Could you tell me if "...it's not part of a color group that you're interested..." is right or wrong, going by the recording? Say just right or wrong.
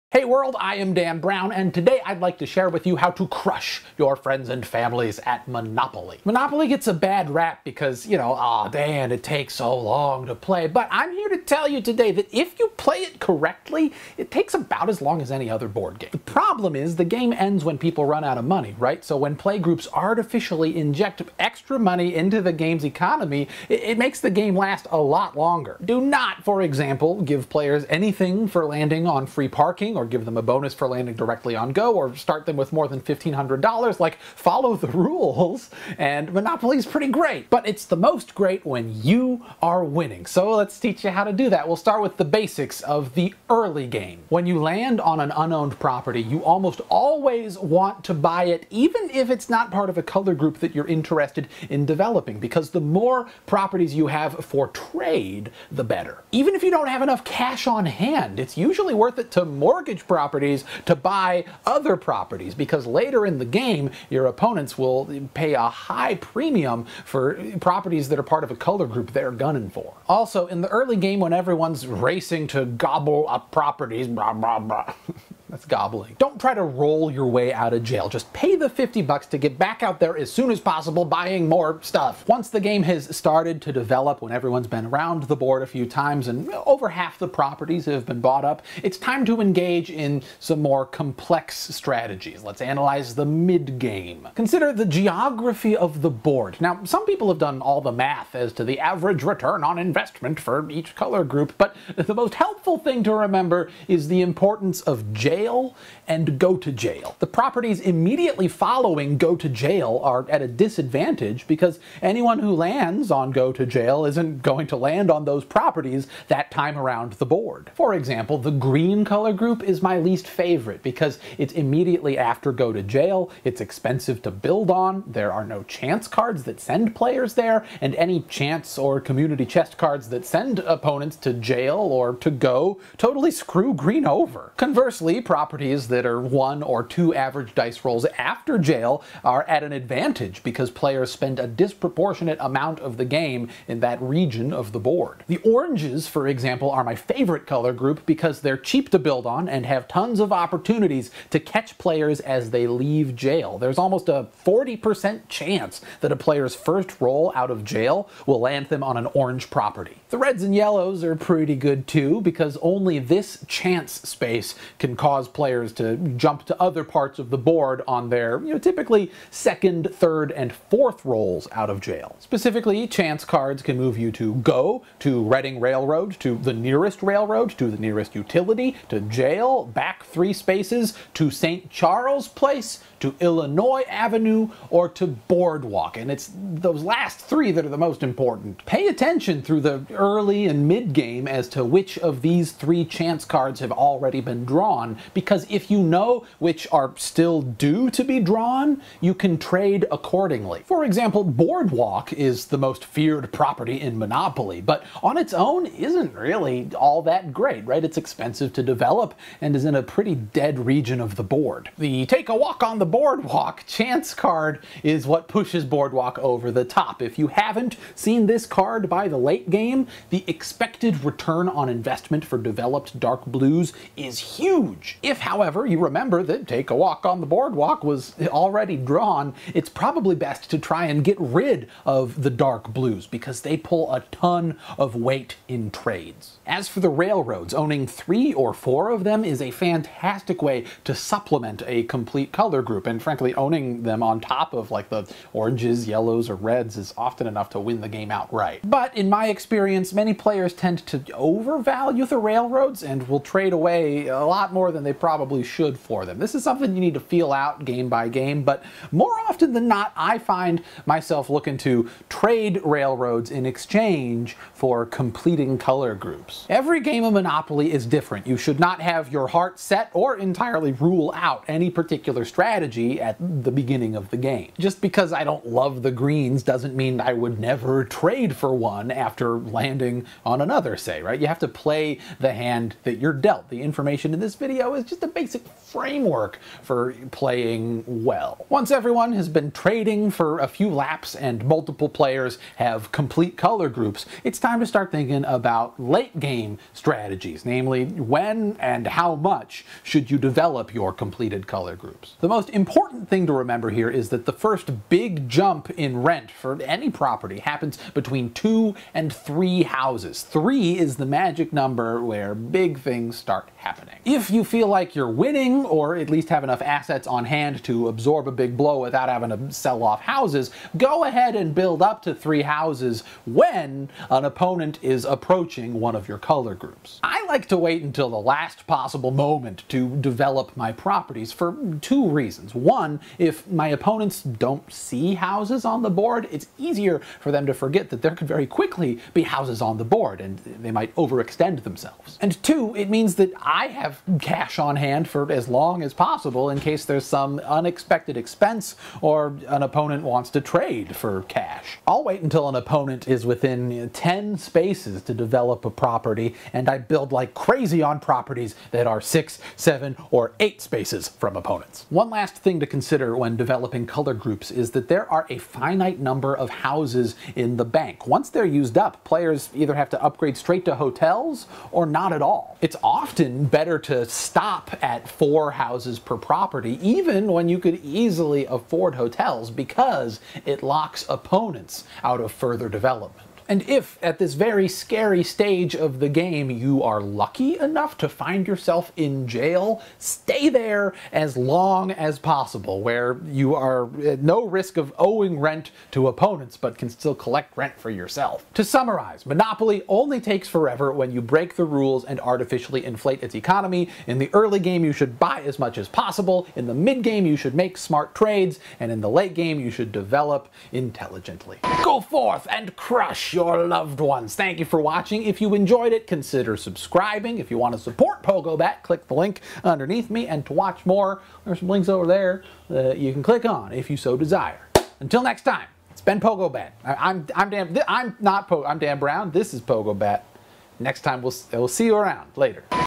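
right.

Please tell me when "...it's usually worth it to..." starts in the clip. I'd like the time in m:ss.
0:58.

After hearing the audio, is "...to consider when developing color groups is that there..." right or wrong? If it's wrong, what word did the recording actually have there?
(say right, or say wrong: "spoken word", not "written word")
right.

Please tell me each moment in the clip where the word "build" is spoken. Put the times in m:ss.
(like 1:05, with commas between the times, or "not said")
2:04, 2:28, 5:21, 5:56.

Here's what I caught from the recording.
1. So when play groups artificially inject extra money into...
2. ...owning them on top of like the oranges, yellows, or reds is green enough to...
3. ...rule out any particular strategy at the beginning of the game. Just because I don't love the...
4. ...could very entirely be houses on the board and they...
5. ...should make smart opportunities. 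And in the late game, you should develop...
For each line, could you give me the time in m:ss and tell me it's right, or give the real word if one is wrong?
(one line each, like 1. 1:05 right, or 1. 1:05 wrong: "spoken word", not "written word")
1. 0:19 right
2. 4:03 wrong: "often", not "green"
3. 4:30 right
4. 5:38 wrong: "quickly", not "entirely"
5. 6:47 wrong: "trades", not "opportunities".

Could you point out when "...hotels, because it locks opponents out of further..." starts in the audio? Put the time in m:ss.
6:18.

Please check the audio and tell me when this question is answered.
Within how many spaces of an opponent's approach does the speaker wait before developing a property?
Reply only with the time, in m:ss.
5:53.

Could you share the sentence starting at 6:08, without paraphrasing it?
Once they're used up, players either have to upgrade straight to hotels or not at all.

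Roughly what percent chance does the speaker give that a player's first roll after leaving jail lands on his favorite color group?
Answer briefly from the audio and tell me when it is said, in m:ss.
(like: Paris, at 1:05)
40%, at 2:34.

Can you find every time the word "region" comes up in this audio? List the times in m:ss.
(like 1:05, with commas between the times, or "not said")
2:24, 3:30.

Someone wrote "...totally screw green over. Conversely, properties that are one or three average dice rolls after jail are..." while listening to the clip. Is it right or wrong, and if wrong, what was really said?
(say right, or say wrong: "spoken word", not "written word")
wrong: "two", not "three".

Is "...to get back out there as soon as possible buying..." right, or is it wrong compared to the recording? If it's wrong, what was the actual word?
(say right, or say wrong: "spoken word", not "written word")
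right.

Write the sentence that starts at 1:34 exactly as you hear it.
Consider the geography of the board.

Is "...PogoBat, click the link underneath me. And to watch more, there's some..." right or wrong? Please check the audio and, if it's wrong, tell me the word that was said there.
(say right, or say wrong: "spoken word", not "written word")
right.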